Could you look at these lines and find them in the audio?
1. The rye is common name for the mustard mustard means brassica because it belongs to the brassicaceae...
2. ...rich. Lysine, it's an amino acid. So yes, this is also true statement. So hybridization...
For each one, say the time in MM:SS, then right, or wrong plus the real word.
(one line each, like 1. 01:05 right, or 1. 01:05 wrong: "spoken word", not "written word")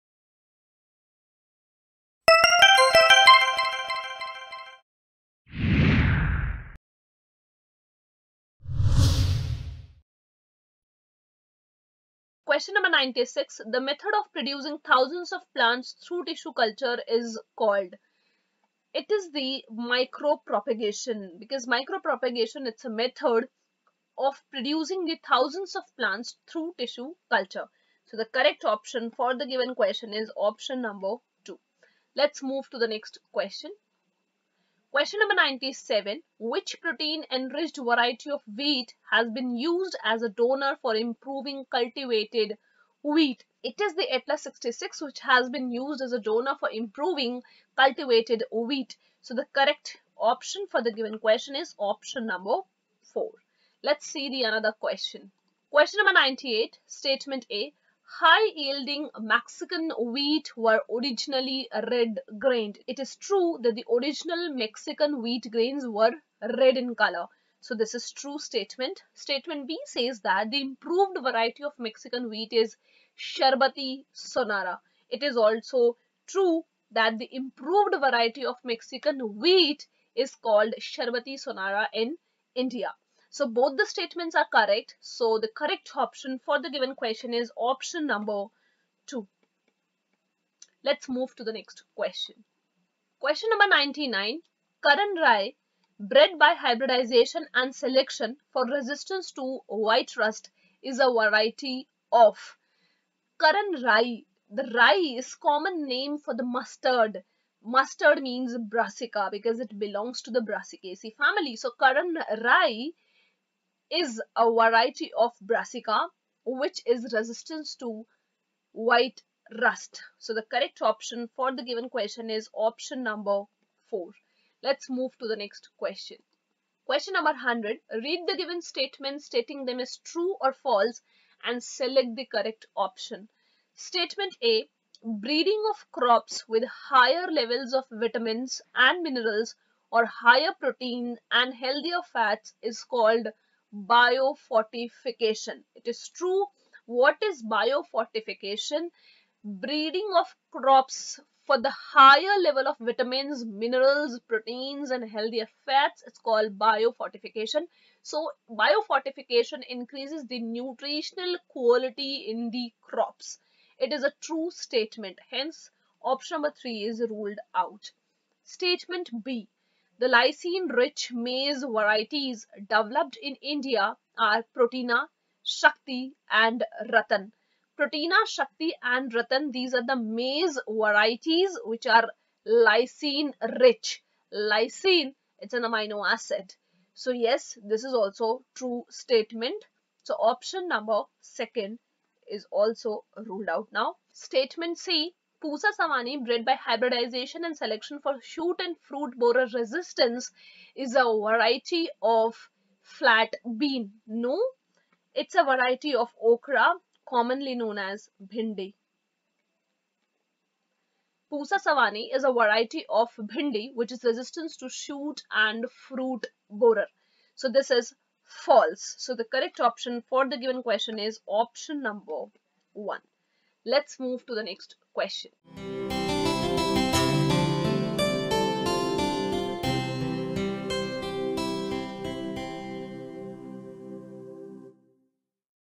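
1. 01:44 right
2. 03:03 wrong: "option", not "hybridization".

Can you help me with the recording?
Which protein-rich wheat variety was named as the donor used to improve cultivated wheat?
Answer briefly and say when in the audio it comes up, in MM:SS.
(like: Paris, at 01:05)
Atlas 66, at 00:44.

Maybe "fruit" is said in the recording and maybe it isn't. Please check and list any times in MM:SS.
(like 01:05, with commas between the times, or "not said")
03:18, 03:35.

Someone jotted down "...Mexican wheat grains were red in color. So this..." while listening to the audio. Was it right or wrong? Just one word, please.
right.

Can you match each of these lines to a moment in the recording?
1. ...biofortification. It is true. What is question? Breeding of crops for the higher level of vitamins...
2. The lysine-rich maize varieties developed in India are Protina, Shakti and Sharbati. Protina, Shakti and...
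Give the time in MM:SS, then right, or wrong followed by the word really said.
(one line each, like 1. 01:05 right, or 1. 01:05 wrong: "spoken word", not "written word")
1. 02:23 wrong: "biofortification", not "question"
2. 02:50 wrong: "Ratan", not "Sharbati".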